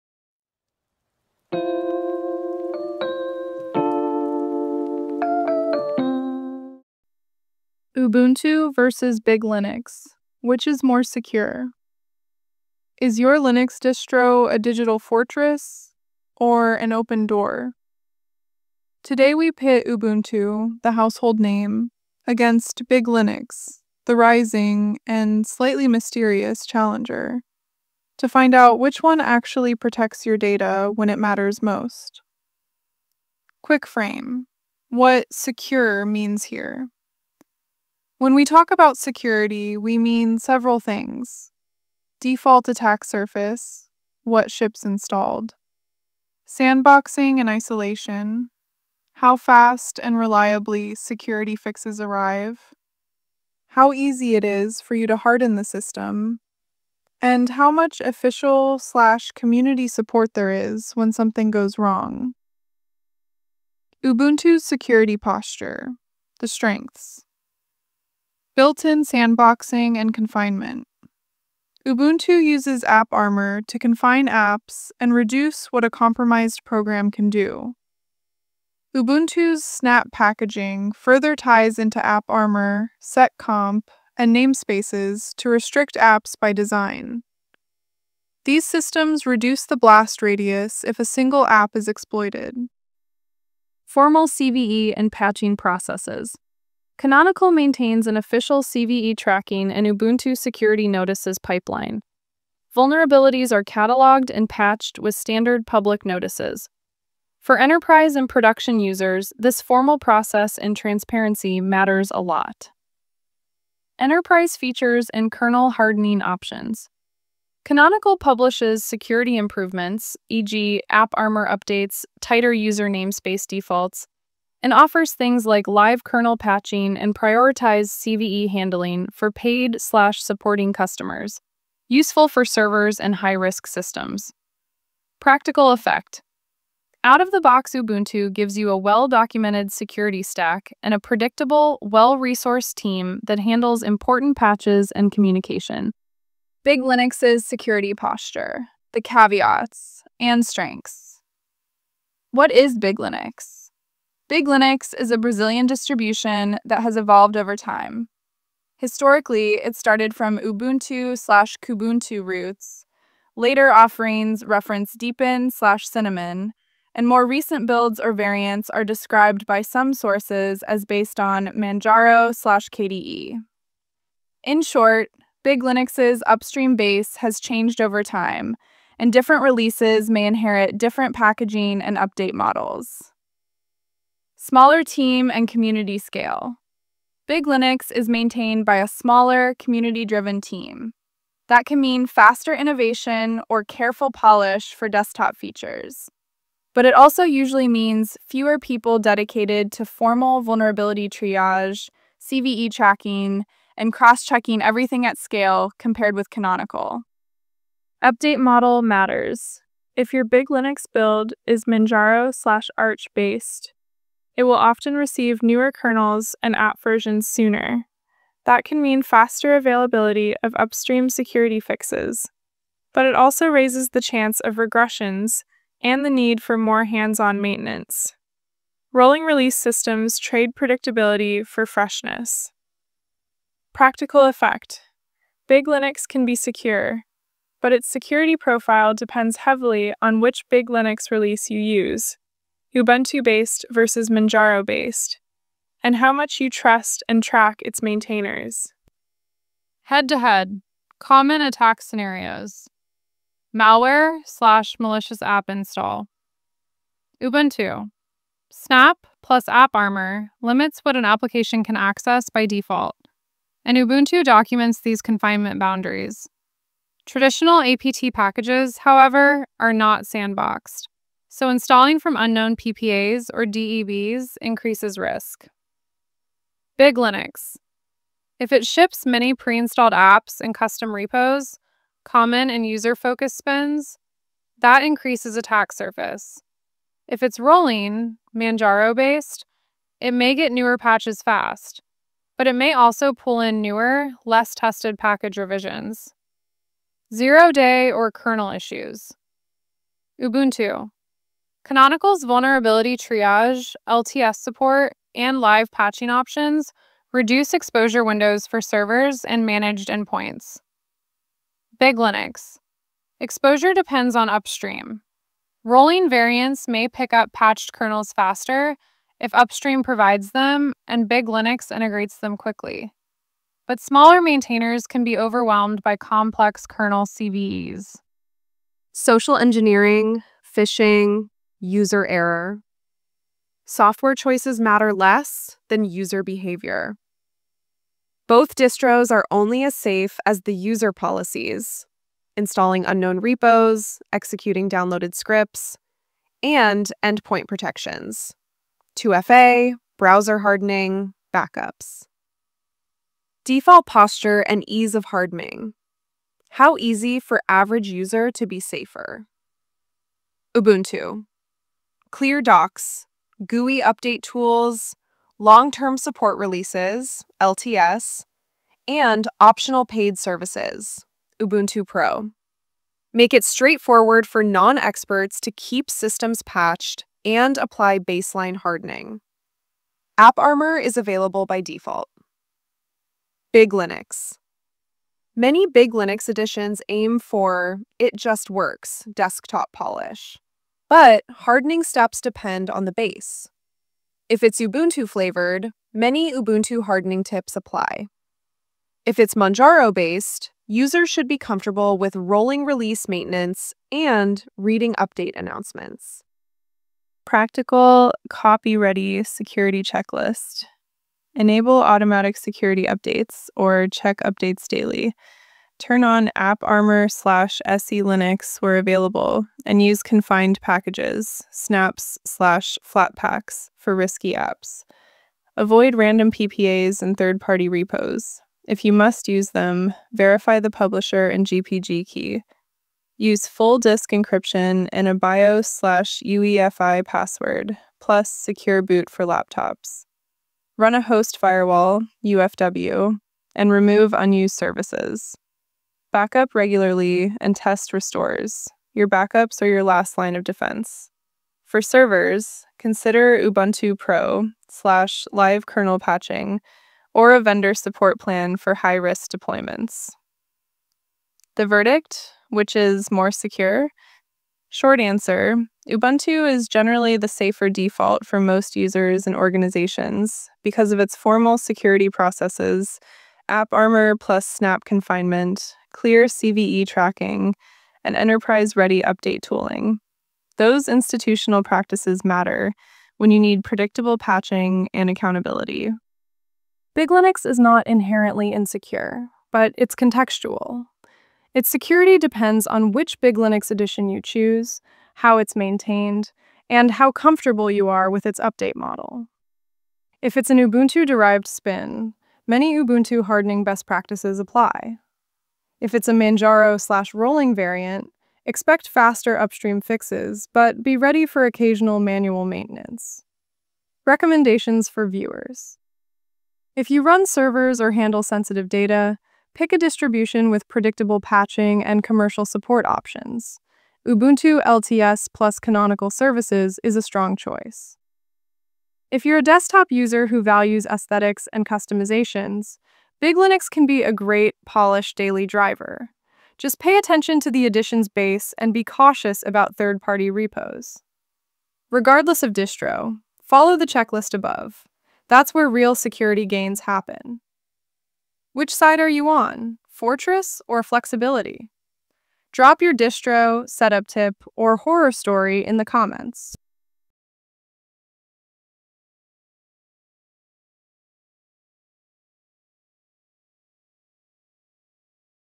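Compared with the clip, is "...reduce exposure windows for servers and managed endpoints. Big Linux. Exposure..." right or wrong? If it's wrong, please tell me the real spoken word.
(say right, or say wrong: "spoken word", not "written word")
right.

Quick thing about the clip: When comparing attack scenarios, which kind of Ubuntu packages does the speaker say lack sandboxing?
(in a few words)
APT packages.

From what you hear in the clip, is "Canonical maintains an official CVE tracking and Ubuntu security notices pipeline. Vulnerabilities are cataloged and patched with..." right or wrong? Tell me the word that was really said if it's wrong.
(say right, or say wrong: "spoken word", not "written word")
right.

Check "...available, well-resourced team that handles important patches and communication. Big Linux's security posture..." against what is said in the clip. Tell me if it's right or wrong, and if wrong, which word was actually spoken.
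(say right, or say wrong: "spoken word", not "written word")
wrong: "predictable", not "available".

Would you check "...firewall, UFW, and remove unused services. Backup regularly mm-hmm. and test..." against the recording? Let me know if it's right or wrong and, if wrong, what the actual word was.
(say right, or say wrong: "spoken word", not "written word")
right.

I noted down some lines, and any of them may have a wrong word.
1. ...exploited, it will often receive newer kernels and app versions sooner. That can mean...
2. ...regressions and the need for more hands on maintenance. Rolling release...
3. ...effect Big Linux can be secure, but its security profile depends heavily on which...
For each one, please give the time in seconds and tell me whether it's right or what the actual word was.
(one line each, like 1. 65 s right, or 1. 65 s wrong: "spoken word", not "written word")
1. 213 s wrong: "based", not "exploited"
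2. 224 s right
3. 234 s right.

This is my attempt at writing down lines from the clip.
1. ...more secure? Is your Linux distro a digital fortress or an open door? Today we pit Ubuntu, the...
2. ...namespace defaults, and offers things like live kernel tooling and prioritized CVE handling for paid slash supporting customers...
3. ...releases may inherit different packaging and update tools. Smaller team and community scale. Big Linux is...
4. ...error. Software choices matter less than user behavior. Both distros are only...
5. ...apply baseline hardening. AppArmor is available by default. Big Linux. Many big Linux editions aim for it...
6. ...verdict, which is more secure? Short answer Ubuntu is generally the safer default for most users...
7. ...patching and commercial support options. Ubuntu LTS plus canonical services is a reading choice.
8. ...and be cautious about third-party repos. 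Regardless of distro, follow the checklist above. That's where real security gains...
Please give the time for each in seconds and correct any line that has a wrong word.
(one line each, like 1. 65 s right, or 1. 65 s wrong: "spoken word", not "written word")
1. 10 s right
2. 122 s wrong: "patching", not "tooling"
3. 179 s wrong: "models", not "tools"
4. 332 s right
5. 377 s right
6. 461 s right
7. 521 s wrong: "strong", not "reading"
8. 538 s right.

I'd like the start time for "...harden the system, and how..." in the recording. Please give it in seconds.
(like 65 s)
55 s.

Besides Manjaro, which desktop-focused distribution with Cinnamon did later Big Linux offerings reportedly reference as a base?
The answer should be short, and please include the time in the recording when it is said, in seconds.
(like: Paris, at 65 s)
Deepin, at 164 s.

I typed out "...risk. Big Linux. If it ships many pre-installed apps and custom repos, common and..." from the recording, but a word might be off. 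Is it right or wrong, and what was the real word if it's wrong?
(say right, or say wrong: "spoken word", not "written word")
right.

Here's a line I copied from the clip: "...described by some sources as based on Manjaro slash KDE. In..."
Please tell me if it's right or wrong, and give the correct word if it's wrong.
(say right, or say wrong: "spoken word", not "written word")
right.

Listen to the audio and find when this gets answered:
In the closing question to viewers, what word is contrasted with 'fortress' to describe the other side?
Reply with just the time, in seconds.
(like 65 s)
550 s.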